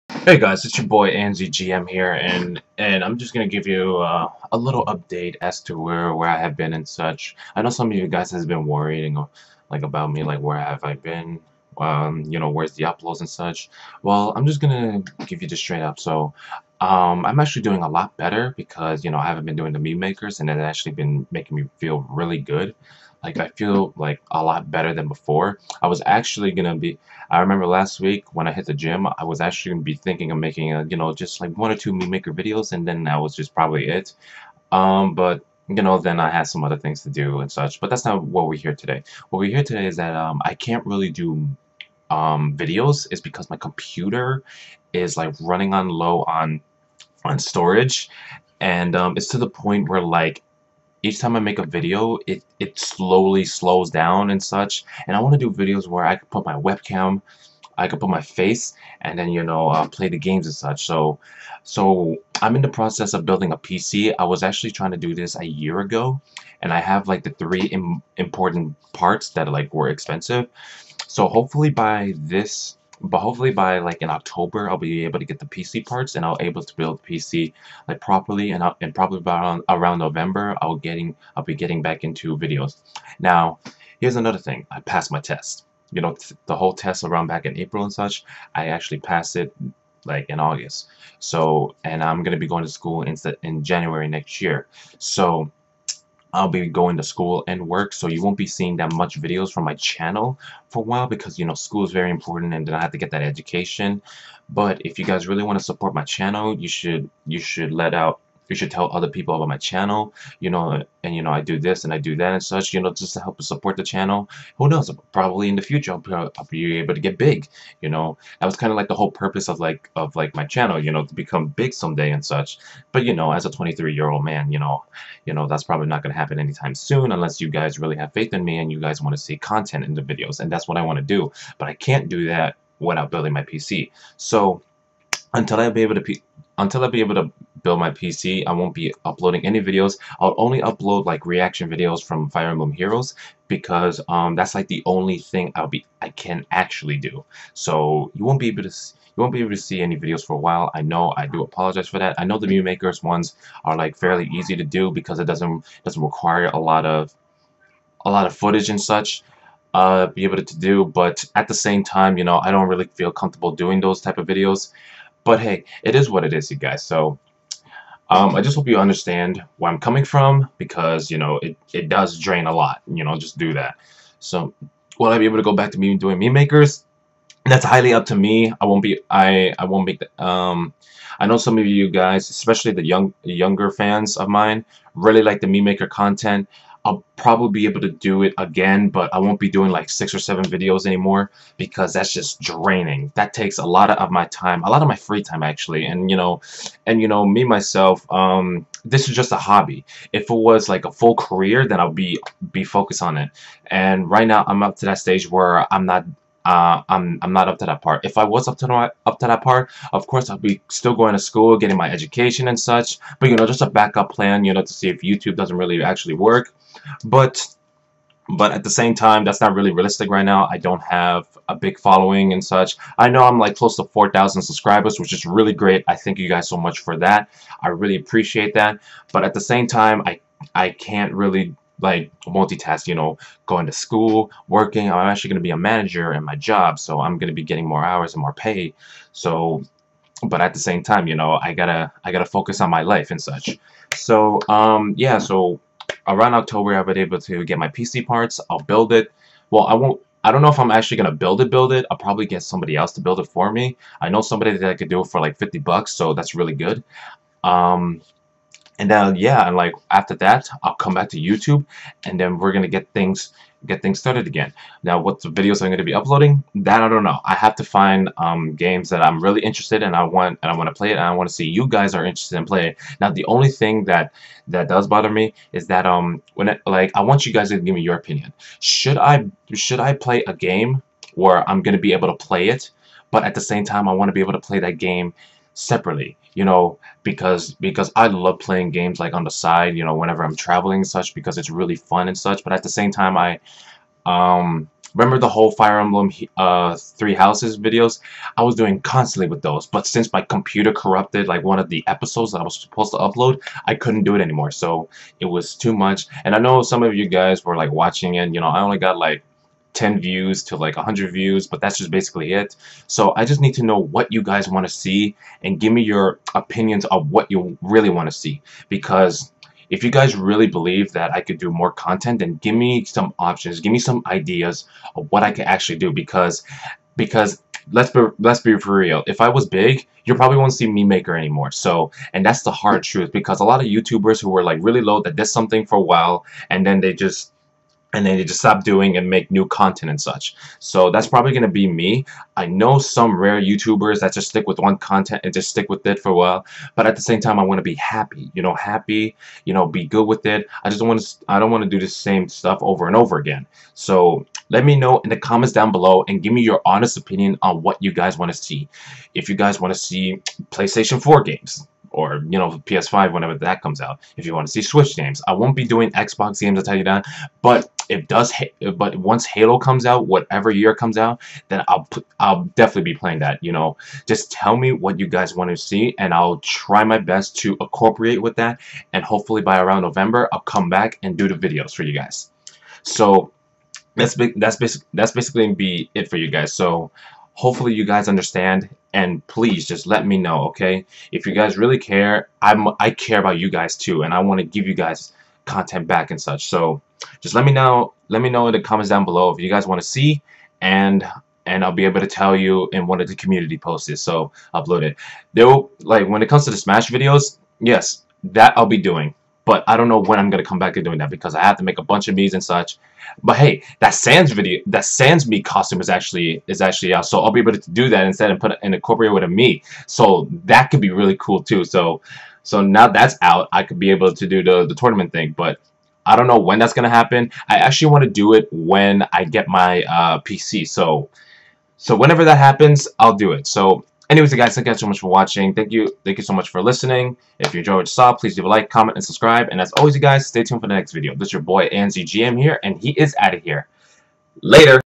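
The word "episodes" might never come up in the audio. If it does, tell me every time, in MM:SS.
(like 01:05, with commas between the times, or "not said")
05:01.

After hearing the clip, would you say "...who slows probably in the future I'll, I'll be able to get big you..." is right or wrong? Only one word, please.
wrong.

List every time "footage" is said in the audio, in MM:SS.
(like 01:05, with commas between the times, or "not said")
02:38.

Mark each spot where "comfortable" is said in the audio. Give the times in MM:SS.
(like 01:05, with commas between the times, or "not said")
02:43.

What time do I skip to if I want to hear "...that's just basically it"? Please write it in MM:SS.
05:11.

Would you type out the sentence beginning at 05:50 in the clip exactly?
I just want to I don't want to do the same stuff over and over again.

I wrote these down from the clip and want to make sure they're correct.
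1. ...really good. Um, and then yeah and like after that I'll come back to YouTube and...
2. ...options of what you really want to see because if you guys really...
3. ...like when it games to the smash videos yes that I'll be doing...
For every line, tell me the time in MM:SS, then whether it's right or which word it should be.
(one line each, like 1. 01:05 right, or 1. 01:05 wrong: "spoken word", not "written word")
1. 04:16 right
2. 05:16 wrong: "opinions", not "options"
3. 06:45 wrong: "comes", not "games".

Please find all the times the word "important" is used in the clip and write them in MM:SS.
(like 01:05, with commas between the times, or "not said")
01:08, 01:42.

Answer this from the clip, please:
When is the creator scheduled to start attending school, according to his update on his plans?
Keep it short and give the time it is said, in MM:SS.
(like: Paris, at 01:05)
January, at 01:33.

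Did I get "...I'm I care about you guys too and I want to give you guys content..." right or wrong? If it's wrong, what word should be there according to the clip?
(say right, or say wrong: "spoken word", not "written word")
right.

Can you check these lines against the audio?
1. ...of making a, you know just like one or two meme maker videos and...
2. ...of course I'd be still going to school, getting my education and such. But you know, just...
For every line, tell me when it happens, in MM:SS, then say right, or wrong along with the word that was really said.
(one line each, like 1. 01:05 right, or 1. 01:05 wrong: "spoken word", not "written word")
1. 00:30 right
2. 03:29 right.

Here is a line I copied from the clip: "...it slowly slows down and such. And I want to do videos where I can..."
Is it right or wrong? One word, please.
right.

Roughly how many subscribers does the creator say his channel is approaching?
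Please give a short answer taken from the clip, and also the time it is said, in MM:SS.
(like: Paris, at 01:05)
4,000, at 03:43.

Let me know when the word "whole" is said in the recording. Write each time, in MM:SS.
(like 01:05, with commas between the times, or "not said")
01:26, 01:58, 04:55.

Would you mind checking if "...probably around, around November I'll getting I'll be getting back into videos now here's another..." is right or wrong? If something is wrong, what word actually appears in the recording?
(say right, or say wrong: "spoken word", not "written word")
right.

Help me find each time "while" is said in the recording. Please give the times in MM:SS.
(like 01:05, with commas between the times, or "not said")
01:40, 02:30, 05:35, 05:46.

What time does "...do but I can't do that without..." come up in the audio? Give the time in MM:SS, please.
02:11.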